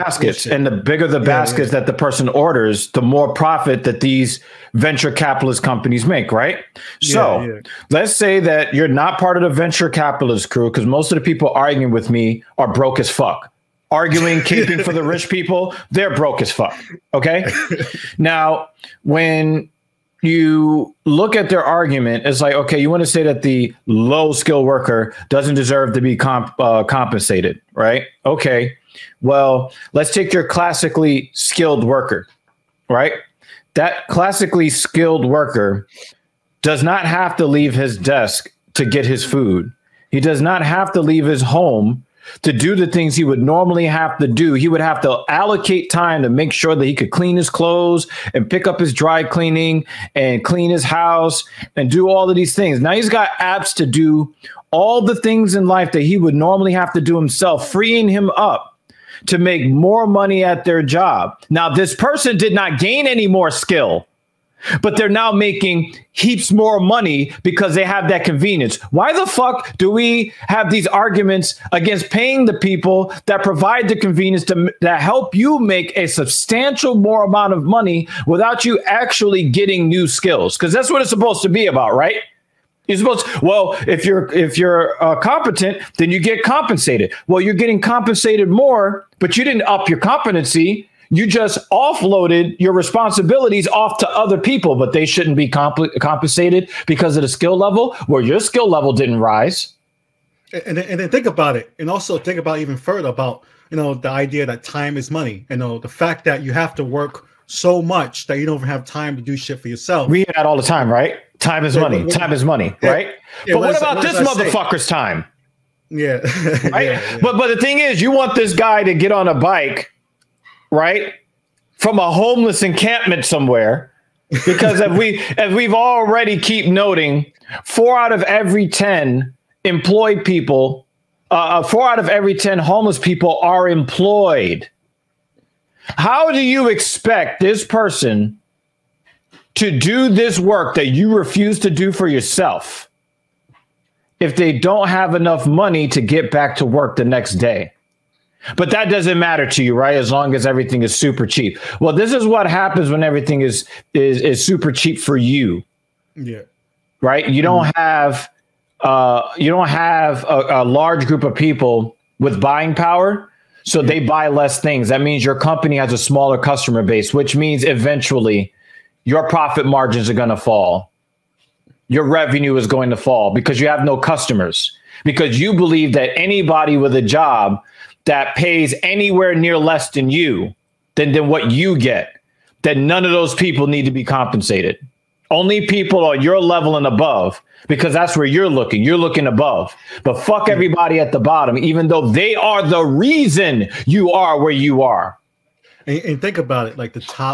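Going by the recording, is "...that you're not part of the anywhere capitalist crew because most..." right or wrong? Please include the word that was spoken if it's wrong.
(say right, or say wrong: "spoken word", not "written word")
wrong: "venture", not "anywhere".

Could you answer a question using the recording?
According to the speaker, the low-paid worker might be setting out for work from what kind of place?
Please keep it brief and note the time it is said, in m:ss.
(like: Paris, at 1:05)
homeless encampment, at 2:02.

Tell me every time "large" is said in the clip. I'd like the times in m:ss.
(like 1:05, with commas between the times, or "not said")
2:40.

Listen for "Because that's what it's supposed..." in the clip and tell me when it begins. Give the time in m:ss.
1:20.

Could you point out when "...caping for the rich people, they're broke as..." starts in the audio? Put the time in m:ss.
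0:14.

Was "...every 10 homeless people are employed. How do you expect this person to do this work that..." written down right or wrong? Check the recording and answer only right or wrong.
right.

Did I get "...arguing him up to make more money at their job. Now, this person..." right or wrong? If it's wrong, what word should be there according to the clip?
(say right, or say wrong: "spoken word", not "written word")
wrong: "freeing", not "arguing".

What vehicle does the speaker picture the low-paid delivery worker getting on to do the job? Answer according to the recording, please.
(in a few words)
bike.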